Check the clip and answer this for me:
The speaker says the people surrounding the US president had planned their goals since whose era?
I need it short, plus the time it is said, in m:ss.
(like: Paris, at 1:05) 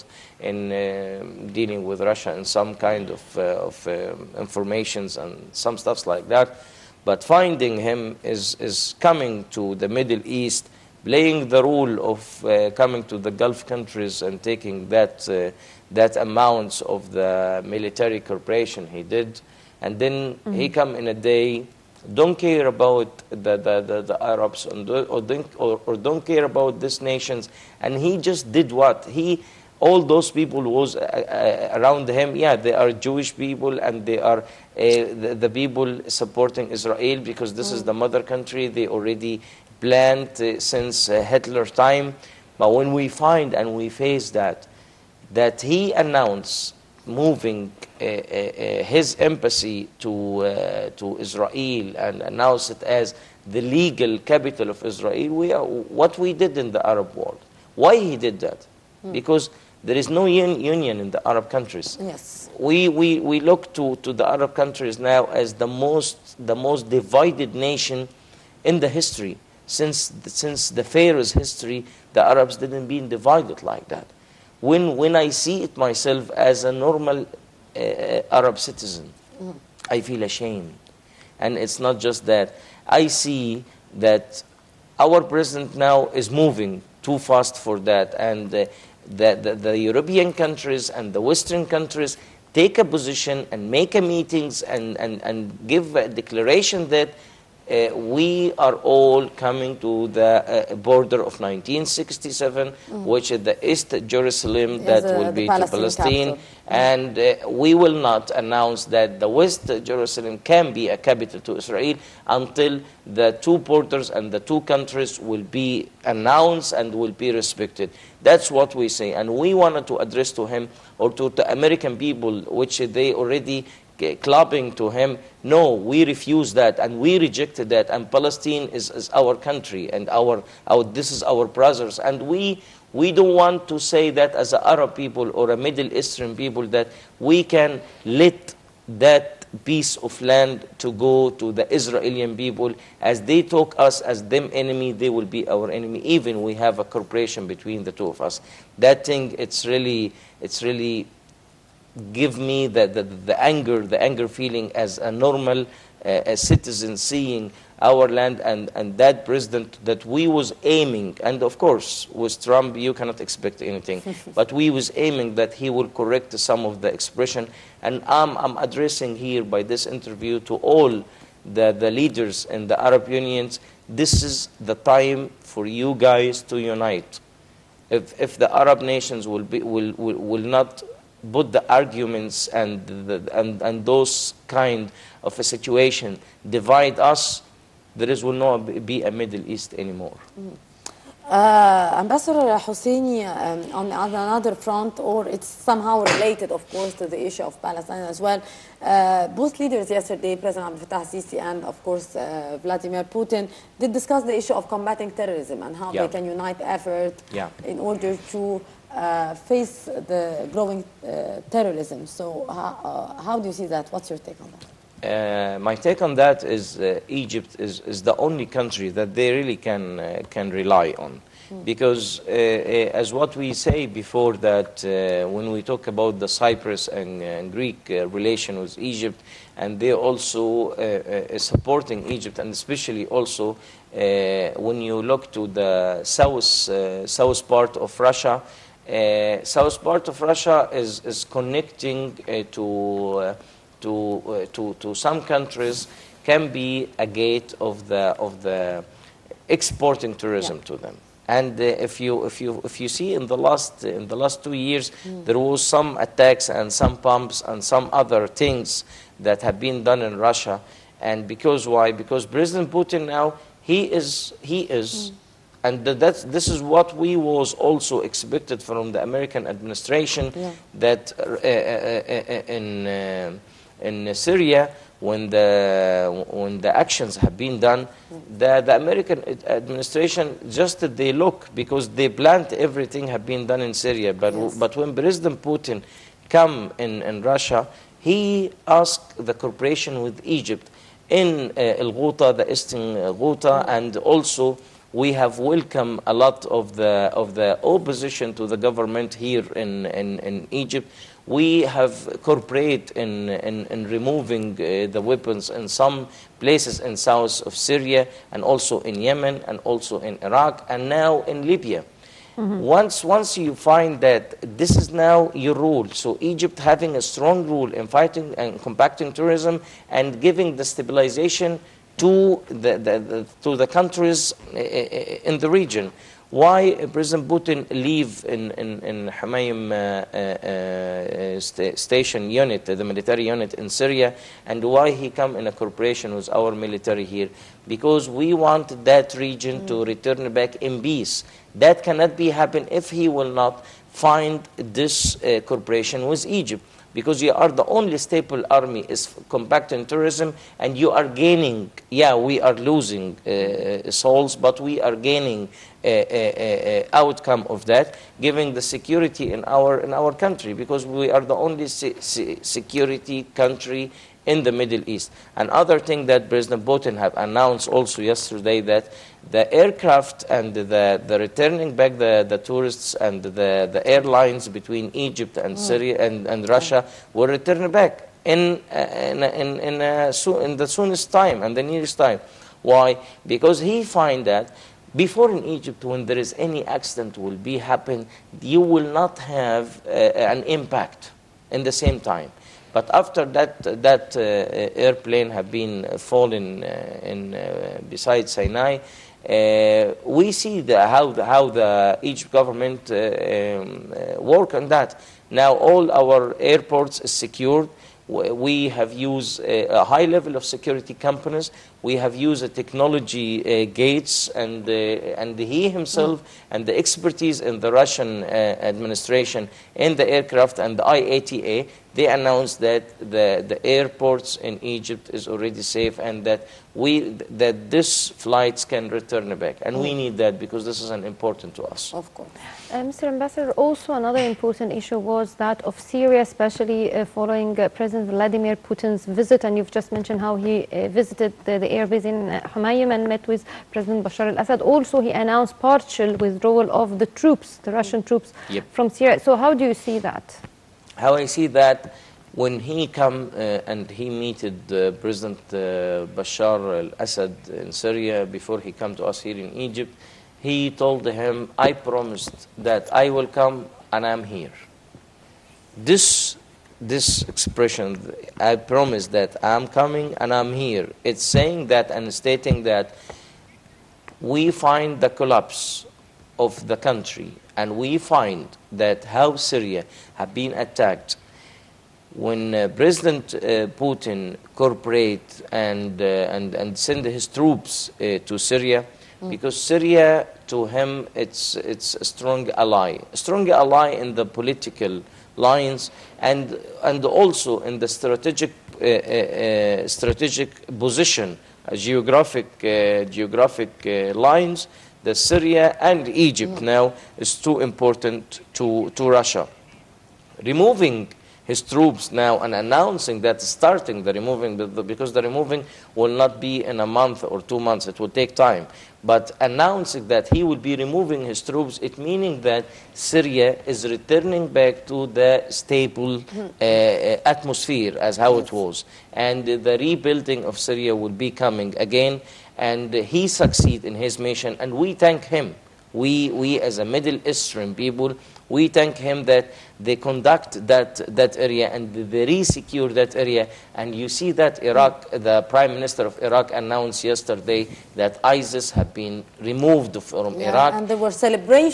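Hitler, at 0:41.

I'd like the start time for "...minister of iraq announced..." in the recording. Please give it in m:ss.
9:05.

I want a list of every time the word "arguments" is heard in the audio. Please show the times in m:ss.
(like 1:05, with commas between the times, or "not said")
3:01.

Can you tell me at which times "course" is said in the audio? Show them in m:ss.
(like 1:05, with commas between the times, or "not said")
2:41, 3:16, 3:21, 7:12.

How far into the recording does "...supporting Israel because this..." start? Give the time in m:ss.
0:36.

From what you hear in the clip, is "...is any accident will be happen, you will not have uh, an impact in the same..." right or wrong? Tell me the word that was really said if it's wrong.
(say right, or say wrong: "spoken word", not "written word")
right.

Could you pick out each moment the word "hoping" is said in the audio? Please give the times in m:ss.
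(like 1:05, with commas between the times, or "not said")
not said.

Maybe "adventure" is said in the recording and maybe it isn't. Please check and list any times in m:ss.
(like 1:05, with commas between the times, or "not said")
not said.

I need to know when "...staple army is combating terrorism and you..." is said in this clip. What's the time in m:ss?
5:47.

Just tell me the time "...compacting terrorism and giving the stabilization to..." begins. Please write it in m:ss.
5:18.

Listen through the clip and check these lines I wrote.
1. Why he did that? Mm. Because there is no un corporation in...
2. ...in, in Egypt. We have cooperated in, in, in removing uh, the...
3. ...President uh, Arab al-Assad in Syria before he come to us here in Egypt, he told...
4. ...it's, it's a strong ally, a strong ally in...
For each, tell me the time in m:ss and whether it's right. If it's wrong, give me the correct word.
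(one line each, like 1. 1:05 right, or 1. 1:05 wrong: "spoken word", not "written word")
1. 0:57 wrong: "union", not "corporation"
2. 4:59 right
3. 7:35 wrong: "Bashar", not "Arab"
4. 8:11 right.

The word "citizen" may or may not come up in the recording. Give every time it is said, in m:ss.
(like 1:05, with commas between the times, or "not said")
1:18, 2:36.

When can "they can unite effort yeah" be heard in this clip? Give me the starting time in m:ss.
3:26.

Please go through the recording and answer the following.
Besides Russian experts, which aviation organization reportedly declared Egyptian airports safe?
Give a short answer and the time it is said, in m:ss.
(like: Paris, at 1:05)
IATA, at 7:00.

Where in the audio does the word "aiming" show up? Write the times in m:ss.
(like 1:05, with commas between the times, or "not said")
2:40, 2:44.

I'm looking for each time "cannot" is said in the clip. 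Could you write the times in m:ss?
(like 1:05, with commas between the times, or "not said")
2:42, 5:41.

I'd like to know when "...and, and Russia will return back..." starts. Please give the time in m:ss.
6:16.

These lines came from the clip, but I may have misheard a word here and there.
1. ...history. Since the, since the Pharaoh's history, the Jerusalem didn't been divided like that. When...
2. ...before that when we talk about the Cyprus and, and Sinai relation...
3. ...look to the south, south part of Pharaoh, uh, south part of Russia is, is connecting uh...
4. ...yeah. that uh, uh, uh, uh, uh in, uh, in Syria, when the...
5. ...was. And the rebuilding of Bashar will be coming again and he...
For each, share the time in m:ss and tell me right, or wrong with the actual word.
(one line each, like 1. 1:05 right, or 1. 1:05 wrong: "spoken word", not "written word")
1. 1:08 wrong: "Arabs", not "Jerusalem"
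2. 3:43 wrong: "Greek", not "Sinai"
3. 3:55 wrong: "Russia", not "Pharaoh"
4. 4:30 right
5. 8:48 wrong: "Syria", not "Bashar".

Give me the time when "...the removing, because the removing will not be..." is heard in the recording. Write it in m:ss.
8:34.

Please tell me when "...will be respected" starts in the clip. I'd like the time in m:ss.
1:56.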